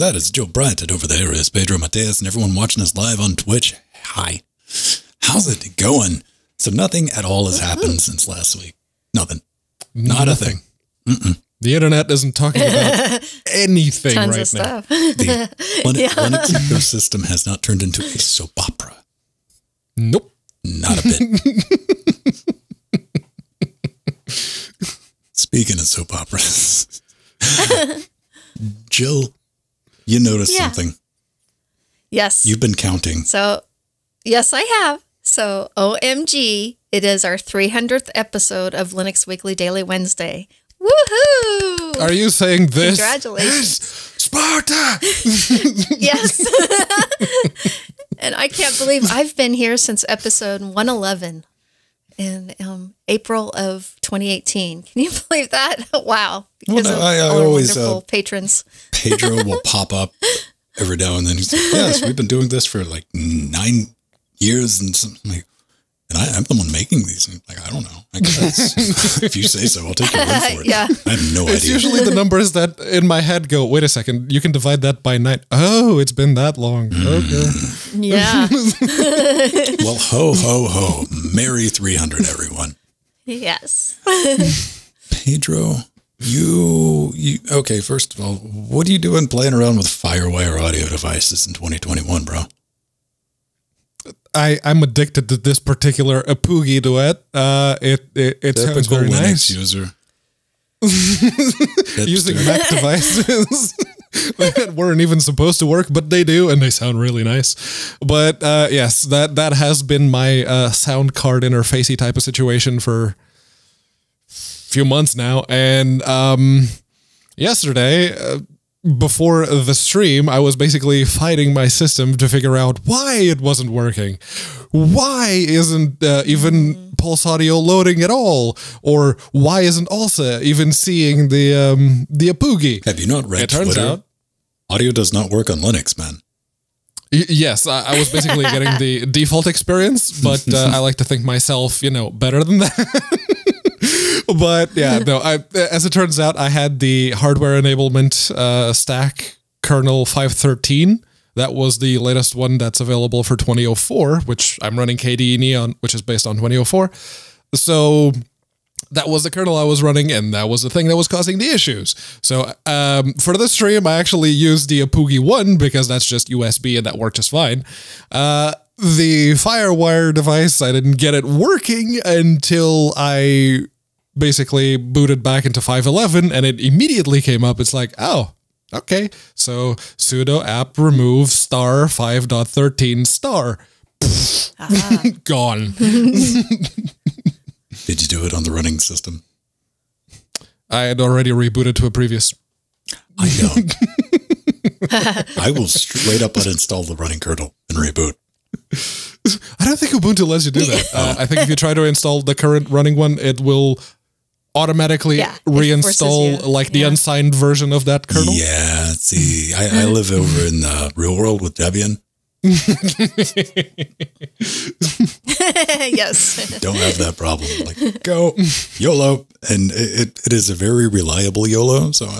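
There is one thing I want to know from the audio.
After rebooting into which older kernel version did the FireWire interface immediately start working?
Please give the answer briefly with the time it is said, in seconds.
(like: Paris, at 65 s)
5.11, at 175 s.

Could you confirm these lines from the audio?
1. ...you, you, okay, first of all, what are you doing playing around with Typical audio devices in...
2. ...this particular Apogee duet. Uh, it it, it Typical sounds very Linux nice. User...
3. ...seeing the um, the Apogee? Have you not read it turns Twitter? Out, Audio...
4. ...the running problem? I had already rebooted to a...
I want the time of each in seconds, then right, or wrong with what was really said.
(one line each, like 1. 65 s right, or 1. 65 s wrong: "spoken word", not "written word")
1. 86 s wrong: "Firewire", not "Typical"
2. 95 s right
3. 130 s right
4. 188 s wrong: "system", not "problem".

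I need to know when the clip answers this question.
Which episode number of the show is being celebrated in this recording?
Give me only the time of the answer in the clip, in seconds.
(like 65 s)
37 s.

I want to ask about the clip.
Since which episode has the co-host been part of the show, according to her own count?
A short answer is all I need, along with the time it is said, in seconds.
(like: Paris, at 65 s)
111, at 50 s.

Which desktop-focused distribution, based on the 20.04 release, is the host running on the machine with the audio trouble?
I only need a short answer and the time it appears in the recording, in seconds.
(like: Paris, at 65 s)
KDE Neon, at 154 s.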